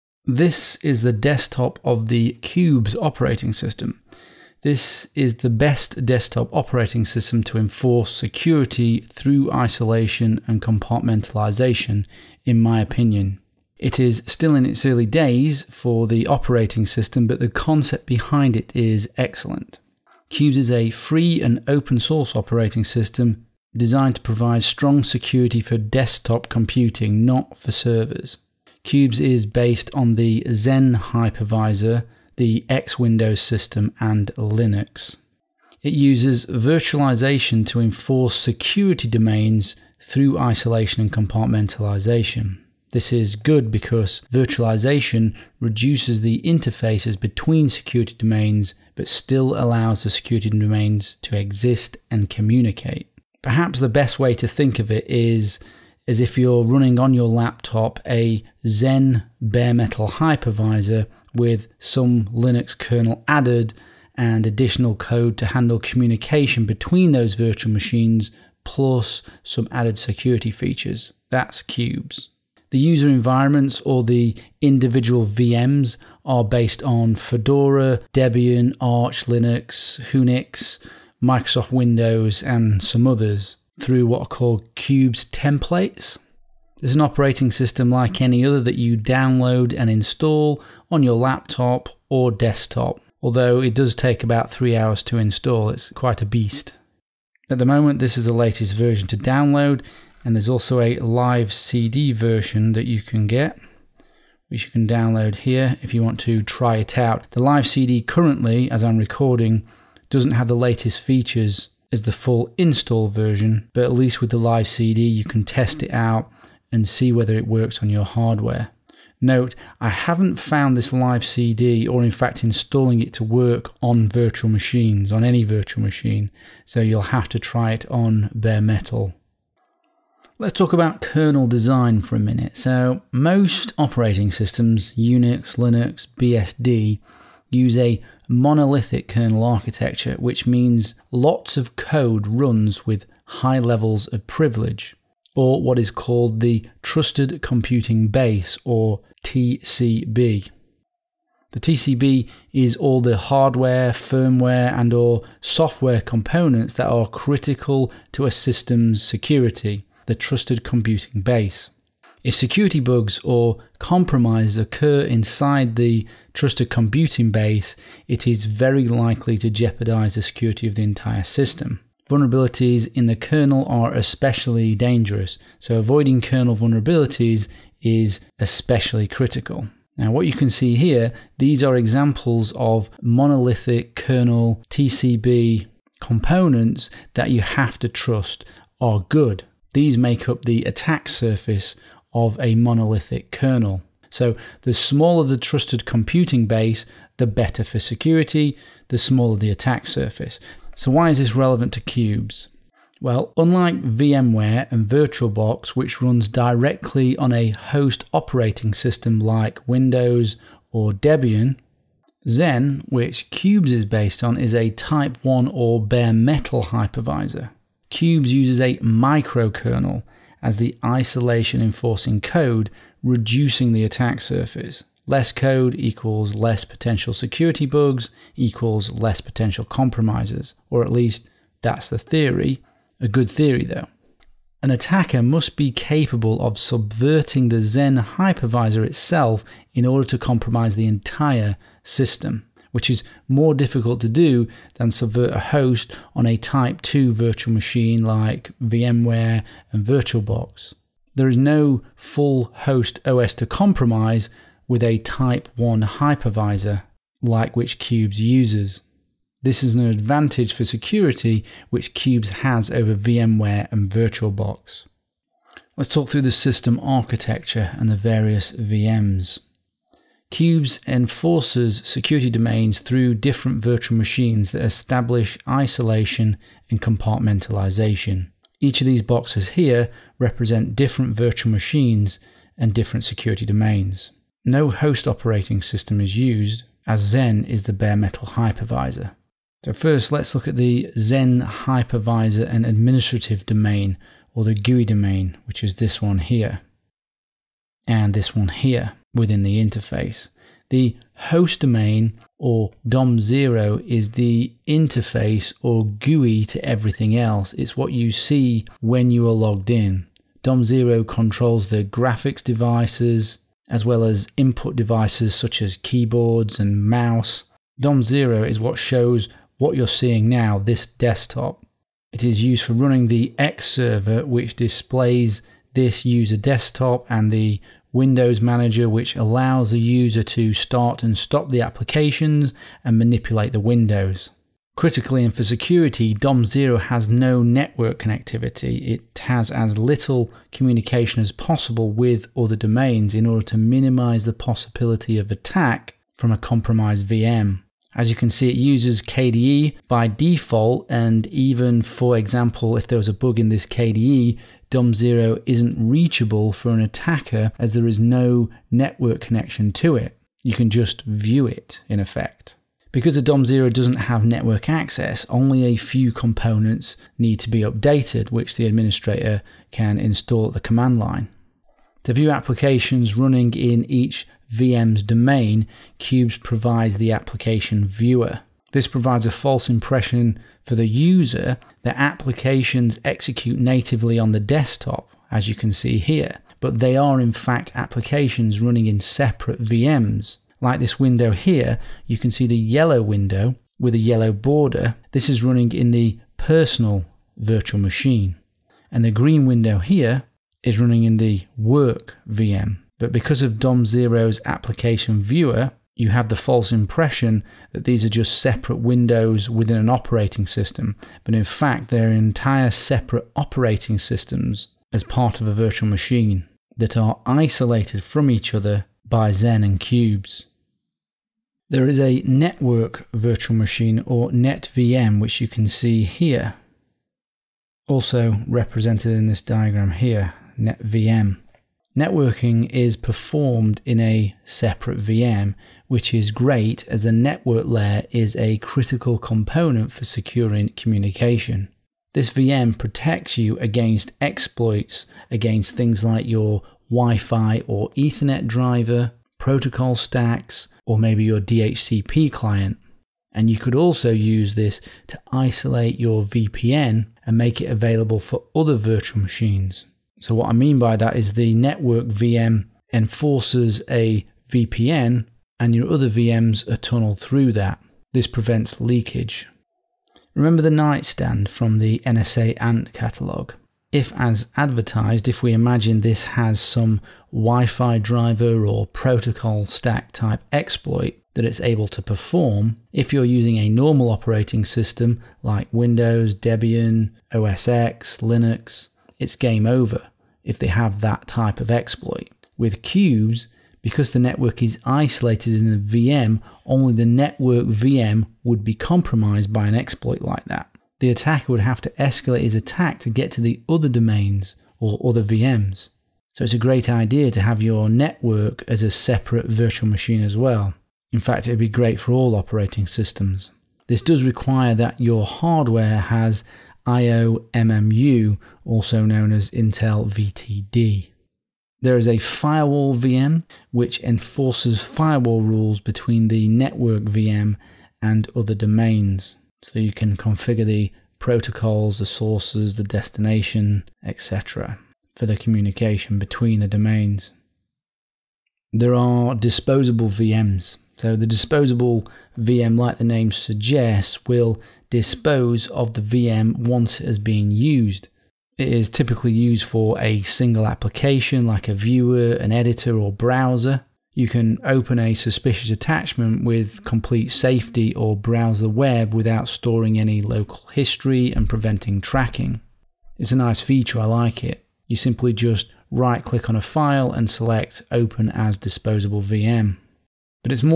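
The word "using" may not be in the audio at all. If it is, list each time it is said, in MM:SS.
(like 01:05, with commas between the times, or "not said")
08:03.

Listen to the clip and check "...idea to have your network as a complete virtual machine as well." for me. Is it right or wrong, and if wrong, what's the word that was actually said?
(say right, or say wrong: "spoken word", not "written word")
wrong: "separate", not "complete".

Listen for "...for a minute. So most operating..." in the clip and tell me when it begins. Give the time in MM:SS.
02:12.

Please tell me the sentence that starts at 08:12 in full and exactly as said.
With Qubes, because the network is isolated in a VM, only the network VM would be compromised by an exploit like that.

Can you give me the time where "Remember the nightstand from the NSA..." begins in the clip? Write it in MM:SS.
07:50.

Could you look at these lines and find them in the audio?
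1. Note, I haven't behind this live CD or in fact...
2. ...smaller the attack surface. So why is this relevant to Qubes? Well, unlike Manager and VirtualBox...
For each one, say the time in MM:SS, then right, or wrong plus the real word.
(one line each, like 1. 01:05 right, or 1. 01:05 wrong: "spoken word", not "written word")
1. 01:59 wrong: "found", not "behind"
2. 03:18 wrong: "VMware", not "Manager".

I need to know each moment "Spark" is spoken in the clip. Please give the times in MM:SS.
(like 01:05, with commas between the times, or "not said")
not said.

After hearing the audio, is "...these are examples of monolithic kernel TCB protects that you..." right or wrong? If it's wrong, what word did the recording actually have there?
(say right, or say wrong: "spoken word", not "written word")
wrong: "components", not "protects".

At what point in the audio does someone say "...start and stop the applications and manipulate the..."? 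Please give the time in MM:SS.
05:30.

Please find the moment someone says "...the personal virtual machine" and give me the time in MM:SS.
06:35.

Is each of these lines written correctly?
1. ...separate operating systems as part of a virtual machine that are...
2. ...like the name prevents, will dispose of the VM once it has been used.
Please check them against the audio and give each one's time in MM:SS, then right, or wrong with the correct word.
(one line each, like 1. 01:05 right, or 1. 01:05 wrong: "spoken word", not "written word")
1. 06:52 right
2. 09:02 wrong: "suggests", not "prevents".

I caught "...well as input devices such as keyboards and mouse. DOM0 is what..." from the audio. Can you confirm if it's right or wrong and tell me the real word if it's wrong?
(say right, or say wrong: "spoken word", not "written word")
right.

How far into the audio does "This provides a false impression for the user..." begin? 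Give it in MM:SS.
06:18.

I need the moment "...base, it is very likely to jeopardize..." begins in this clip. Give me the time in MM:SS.
02:47.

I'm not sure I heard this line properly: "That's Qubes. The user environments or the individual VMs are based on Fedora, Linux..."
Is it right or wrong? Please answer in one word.
wrong.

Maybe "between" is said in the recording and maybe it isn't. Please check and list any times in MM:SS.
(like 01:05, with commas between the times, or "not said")
00:47, 01:06, 08:45, 08:56.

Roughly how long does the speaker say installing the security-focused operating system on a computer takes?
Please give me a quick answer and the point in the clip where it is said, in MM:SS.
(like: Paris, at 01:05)
3 hours, at 01:34.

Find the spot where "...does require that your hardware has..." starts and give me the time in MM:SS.
08:34.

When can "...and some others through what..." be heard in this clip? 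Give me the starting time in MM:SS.
01:22.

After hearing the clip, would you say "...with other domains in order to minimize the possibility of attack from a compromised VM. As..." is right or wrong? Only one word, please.
right.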